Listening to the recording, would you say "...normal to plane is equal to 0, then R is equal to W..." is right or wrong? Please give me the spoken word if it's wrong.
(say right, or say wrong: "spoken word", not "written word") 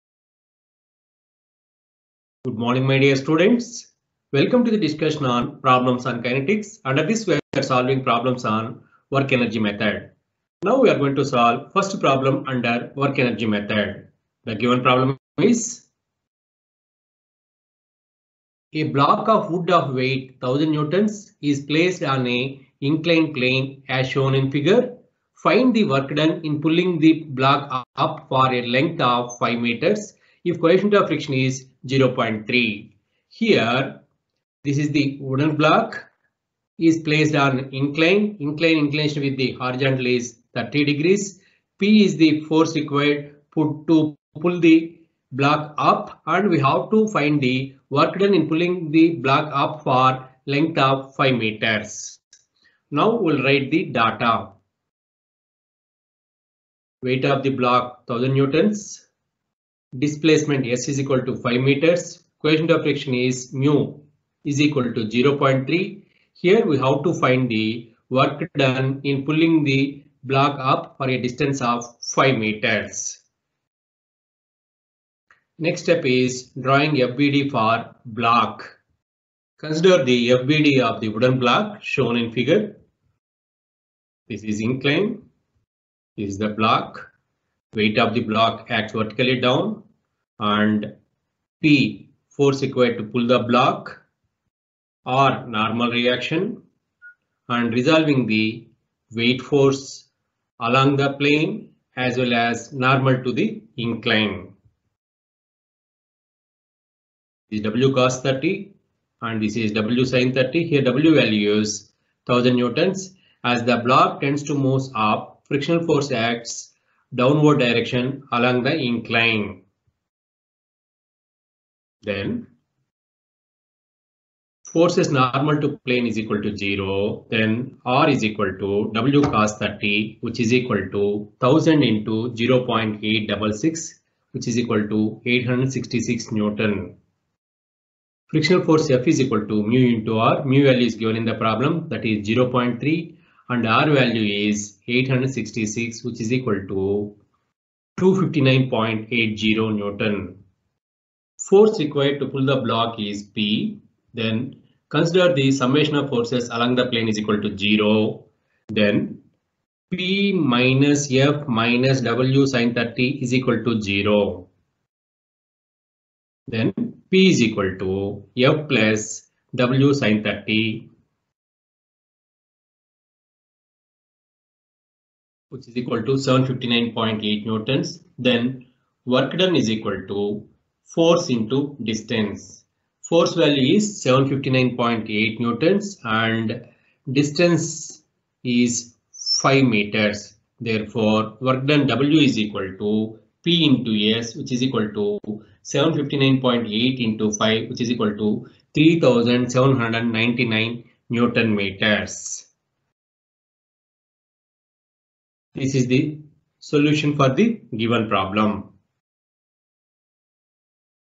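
right.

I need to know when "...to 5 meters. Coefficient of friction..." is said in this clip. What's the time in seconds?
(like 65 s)
61 s.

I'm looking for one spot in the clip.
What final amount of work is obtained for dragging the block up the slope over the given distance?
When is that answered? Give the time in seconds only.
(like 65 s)
198 s.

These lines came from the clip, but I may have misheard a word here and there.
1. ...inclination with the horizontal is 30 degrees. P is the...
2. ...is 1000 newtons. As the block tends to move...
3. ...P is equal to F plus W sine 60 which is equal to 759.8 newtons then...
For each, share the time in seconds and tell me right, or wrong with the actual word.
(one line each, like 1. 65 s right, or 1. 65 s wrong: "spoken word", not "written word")
1. 38 s right
2. 111 s right
3. 167 s wrong: "30", not "60".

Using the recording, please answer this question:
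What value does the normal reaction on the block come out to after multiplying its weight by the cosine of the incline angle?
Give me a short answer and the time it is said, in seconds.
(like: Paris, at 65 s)
866 newtons, at 135 s.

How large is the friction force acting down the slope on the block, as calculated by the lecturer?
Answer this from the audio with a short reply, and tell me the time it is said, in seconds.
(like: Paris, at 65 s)
259.80 newtons, at 147 s.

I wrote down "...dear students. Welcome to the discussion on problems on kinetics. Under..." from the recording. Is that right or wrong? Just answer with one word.
right.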